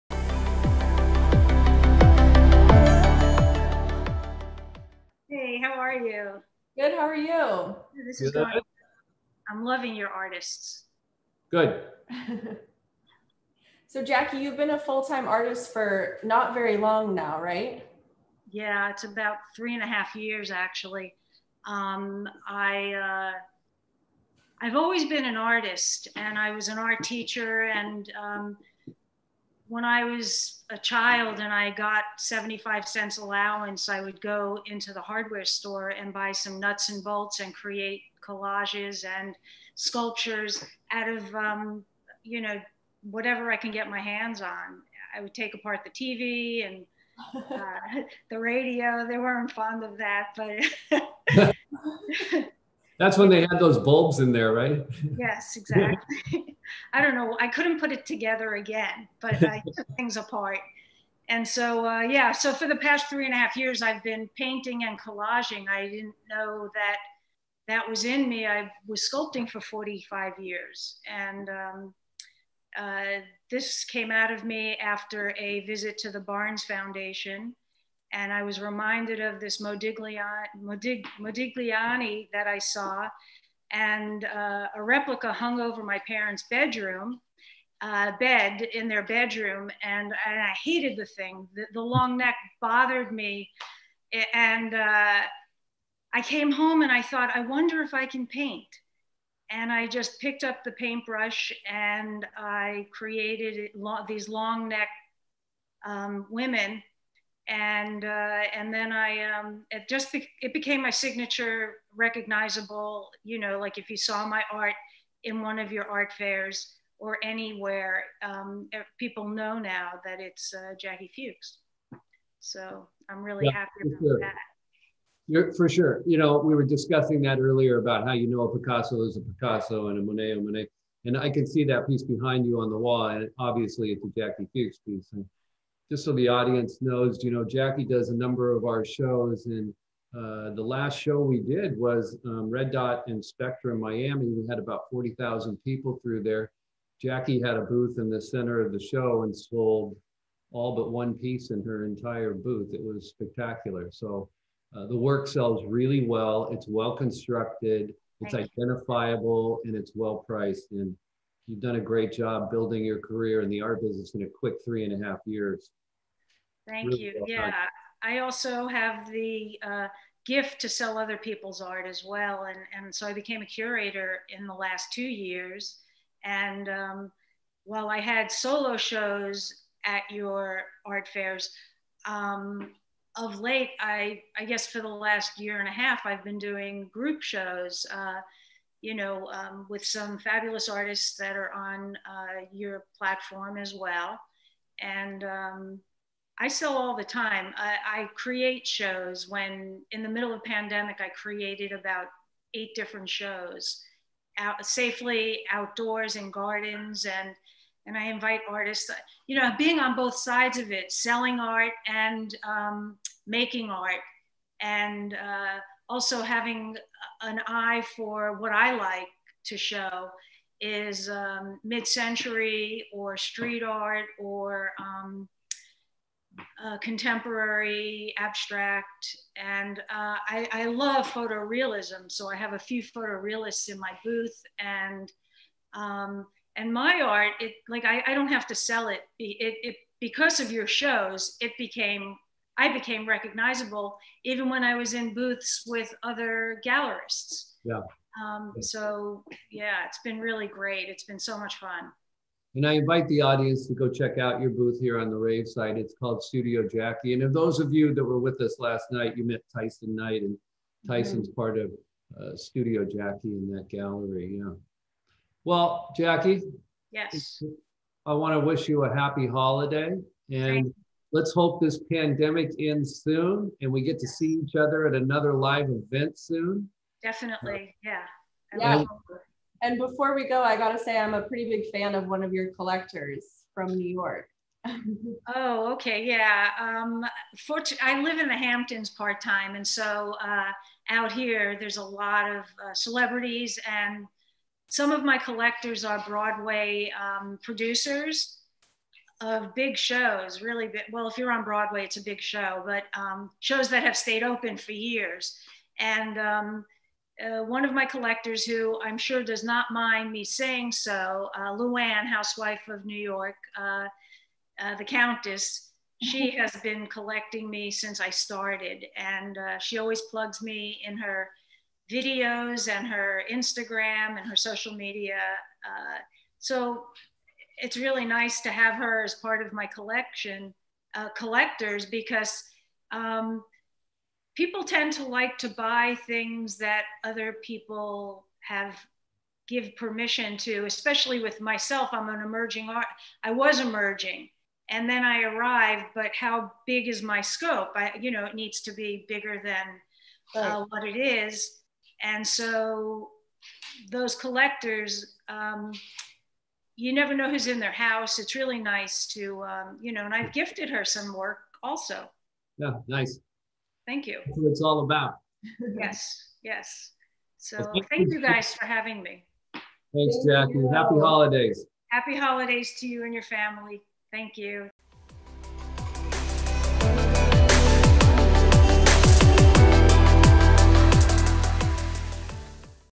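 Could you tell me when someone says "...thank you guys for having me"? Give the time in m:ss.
6:07.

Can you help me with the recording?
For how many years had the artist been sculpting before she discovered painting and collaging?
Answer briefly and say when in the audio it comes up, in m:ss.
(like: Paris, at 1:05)
45, at 1:09.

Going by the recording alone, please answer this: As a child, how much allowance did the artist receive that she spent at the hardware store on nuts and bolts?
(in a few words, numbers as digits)
75 cents.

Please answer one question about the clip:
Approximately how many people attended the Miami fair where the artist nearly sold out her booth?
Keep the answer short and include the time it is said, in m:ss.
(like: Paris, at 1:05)
40,000, at 2:24.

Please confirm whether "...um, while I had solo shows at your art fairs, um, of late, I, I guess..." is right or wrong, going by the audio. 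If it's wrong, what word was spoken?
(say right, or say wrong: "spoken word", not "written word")
right.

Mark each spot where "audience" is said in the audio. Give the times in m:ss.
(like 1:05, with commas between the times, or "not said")
2:16, 4:13.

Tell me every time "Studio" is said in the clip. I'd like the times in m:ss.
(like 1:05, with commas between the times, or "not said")
4:16, 4:22.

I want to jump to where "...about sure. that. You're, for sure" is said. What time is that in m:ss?
2:03.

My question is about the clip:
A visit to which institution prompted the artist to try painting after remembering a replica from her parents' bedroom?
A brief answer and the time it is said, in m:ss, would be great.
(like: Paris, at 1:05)
Barnes Foundation, at 1:16.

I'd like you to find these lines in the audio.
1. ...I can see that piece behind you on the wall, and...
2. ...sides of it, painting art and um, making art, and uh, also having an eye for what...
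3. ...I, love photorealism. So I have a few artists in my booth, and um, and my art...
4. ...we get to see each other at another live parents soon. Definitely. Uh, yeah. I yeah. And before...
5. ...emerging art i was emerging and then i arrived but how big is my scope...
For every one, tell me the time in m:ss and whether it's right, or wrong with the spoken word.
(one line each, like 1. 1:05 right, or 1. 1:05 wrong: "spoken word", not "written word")
1. 2:11 right
2. 3:30 wrong: "selling", not "painting"
3. 3:50 wrong: "photorealists", not "artists"
4. 4:33 wrong: "event", not "parents"
5. 5:42 right.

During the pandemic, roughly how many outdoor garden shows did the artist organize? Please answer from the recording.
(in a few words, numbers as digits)
8.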